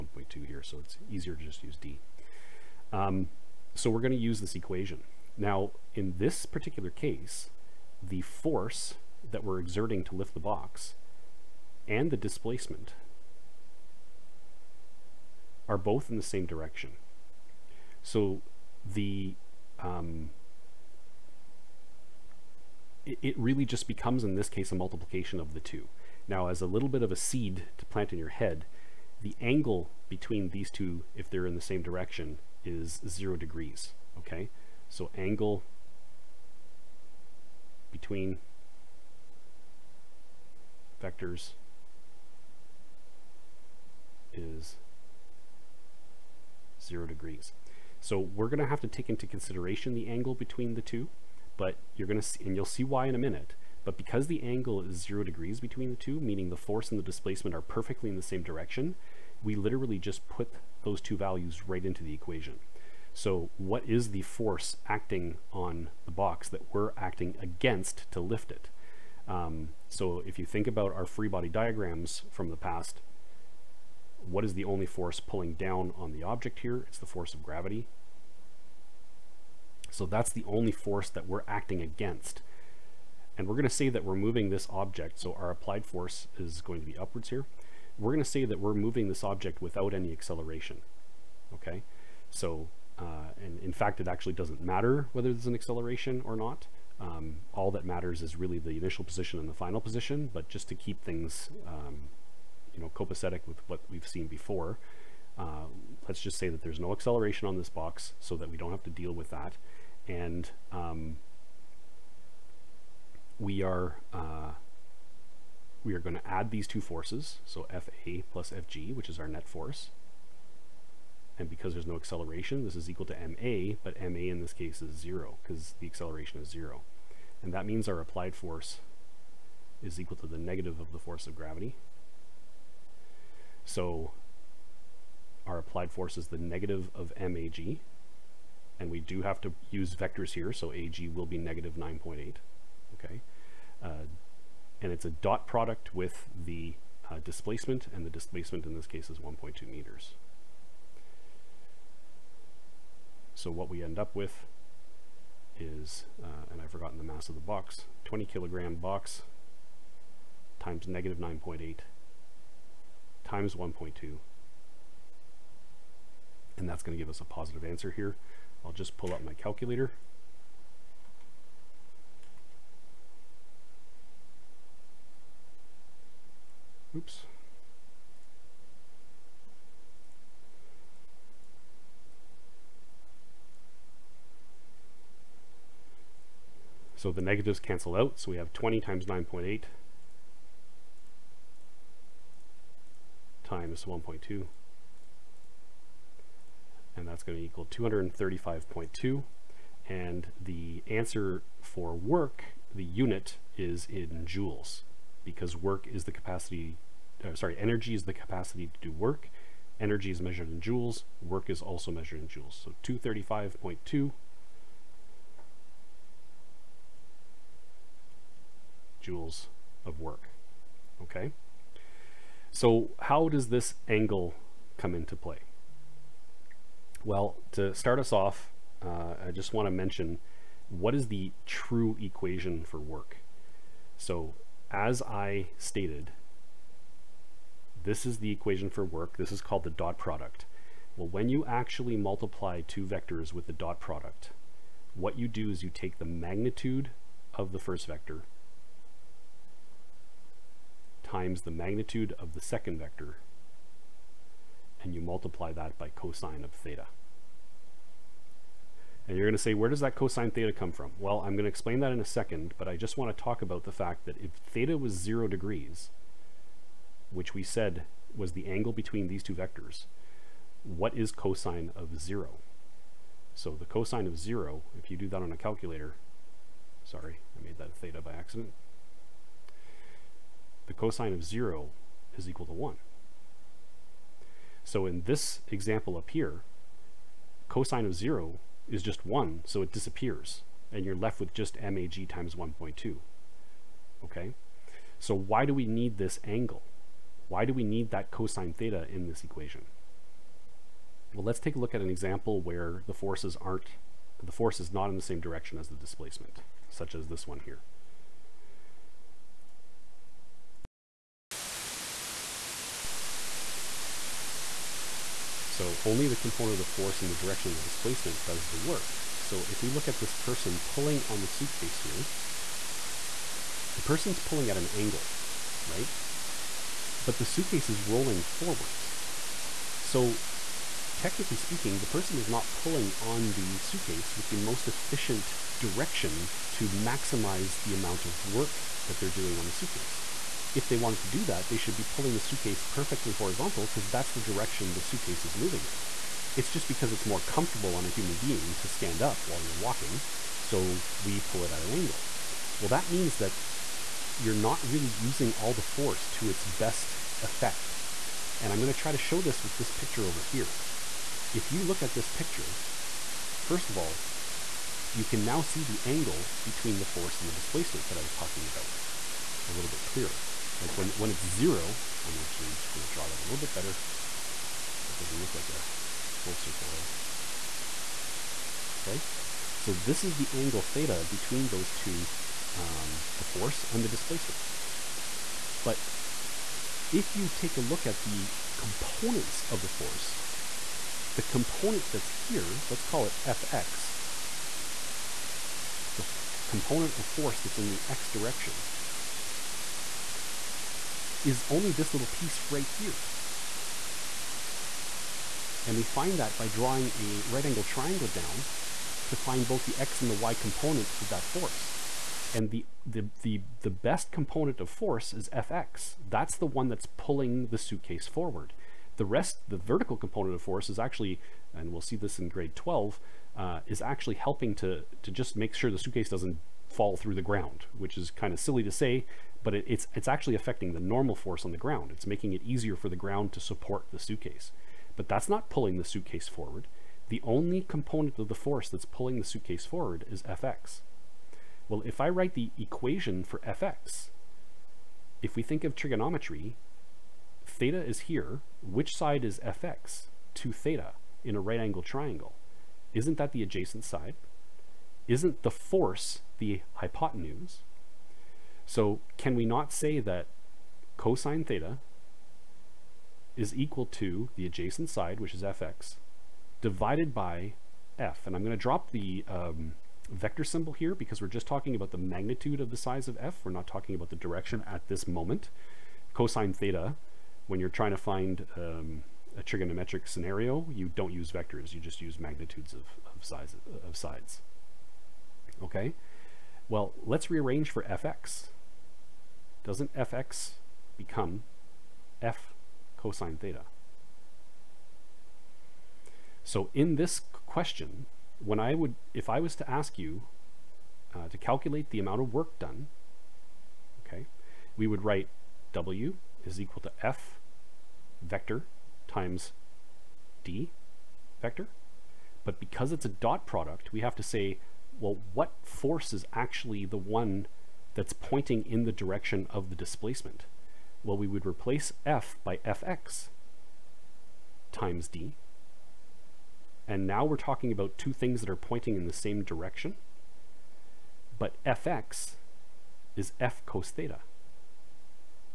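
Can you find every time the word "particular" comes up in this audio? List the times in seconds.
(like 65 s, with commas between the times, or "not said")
6 s.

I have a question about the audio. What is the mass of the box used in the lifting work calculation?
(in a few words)
20 kilograms.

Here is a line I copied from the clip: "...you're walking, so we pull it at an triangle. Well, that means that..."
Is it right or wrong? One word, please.
wrong.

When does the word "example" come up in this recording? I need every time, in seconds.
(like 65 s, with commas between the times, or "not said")
285 s, 301 s.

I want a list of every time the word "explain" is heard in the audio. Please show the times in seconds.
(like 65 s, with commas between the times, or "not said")
261 s.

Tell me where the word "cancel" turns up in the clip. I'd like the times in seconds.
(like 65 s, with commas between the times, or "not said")
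187 s.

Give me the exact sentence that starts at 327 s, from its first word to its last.
But the suitcase is rolling forwards.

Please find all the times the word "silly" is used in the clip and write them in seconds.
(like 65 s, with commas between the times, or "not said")
428 s.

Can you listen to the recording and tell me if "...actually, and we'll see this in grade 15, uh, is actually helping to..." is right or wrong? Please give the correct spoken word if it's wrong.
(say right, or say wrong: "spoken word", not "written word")
wrong: "12", not "15".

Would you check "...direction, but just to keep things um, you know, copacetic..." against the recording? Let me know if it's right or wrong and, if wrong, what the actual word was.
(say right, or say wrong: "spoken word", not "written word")
wrong: "position", not "direction".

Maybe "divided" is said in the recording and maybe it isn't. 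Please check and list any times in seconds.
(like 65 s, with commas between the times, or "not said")
466 s.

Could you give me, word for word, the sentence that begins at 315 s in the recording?
So only the component of the force and the direction of the displacement does the work.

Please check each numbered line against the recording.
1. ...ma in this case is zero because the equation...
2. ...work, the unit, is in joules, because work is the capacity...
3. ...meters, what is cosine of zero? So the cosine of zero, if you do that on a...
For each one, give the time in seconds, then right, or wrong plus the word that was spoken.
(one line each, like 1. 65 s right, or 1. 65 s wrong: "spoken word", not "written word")
1. 124 s wrong: "acceleration", not "equation"
2. 201 s right
3. 269 s wrong: "vectors", not "meters".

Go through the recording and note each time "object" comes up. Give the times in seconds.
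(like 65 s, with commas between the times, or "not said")
76 s, 84 s, 89 s.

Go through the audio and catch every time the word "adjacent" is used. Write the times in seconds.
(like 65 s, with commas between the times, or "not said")
453 s, 464 s.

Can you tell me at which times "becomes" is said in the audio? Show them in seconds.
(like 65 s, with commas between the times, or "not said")
23 s, 490 s.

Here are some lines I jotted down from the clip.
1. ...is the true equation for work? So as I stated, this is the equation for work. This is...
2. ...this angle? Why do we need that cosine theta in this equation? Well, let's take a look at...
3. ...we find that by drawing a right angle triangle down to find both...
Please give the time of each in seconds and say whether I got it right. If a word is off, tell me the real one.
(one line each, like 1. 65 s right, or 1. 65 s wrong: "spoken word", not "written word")
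1. 230 s right
2. 295 s right
3. 405 s right.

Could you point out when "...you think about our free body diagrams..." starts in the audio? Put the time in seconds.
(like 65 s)
70 s.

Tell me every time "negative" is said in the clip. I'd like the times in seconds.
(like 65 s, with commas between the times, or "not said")
130 s, 136 s, 141 s, 160 s, 187 s.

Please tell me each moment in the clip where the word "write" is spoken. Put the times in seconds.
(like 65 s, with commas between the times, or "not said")
442 s, 505 s.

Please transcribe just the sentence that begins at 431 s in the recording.
It's making it easier for the ground to support the suitcase.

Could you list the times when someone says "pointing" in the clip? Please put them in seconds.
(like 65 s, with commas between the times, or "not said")
518 s, 528 s.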